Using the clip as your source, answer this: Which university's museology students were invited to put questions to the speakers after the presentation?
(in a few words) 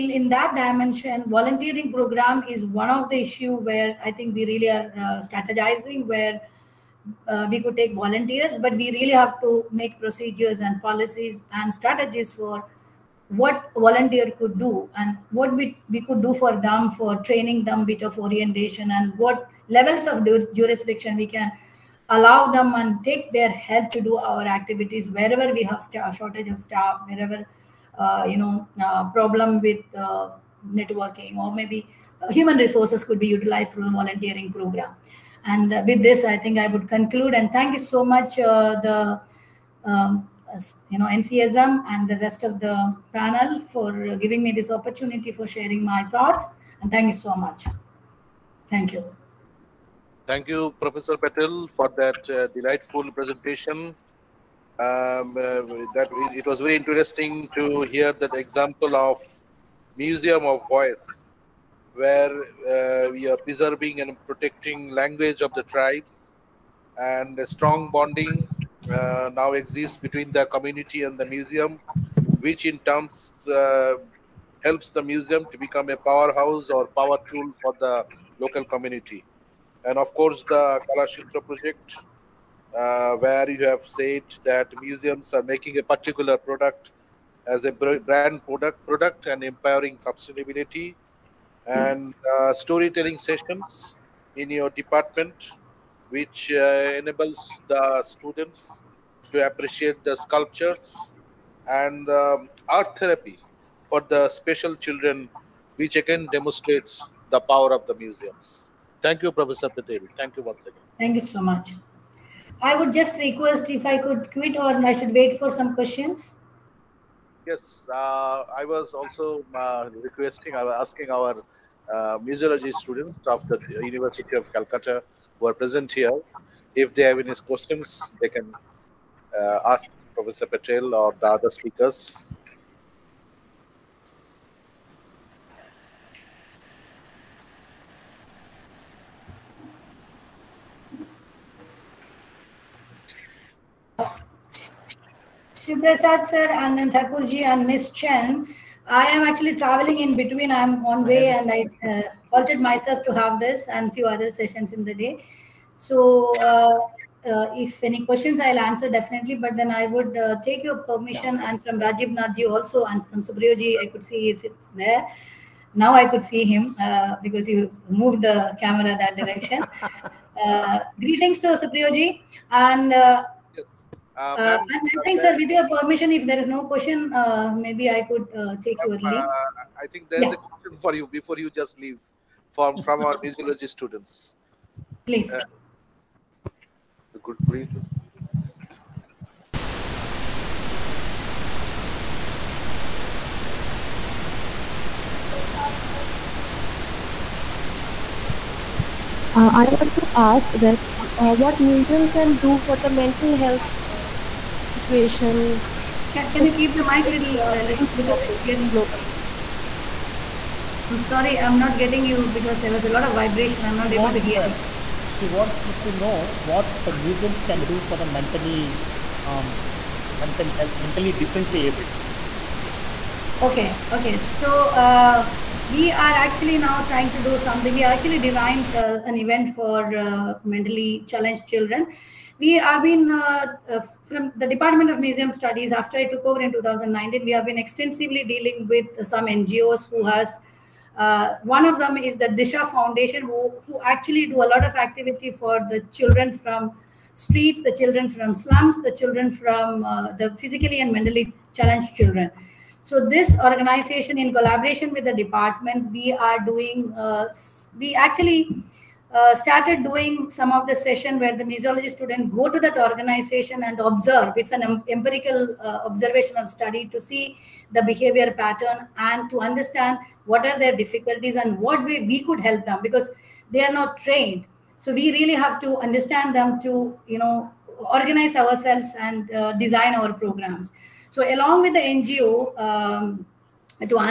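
University of Calcutta.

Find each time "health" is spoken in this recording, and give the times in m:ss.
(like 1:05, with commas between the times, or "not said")
3:23, 3:40.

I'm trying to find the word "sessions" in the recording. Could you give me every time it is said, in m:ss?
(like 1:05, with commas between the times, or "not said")
1:33, 2:34, 4:20.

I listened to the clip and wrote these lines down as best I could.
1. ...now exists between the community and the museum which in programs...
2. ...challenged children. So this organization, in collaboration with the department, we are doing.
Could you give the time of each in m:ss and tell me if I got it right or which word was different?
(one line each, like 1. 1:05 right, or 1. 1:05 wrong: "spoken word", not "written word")
1. 1:09 wrong: "terms", not "programs"
2. 4:11 right.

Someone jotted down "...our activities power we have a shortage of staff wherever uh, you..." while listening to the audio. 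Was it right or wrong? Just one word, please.
wrong.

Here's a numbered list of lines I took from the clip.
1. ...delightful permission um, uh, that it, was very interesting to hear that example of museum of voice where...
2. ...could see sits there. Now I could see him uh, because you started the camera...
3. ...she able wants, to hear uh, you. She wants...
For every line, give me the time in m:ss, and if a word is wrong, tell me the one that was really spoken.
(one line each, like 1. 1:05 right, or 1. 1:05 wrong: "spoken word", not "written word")
1. 0:52 wrong: "presentation", not "permission"
2. 2:43 wrong: "moved", not "started"
3. 3:33 right.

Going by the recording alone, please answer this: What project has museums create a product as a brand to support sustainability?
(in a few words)
Kalashitra.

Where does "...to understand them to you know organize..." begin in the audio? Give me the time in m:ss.
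4:35.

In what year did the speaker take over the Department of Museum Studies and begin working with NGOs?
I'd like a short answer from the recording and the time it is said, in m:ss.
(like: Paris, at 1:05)
2019, at 3:56.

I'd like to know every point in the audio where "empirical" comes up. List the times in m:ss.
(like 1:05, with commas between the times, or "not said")
4:24.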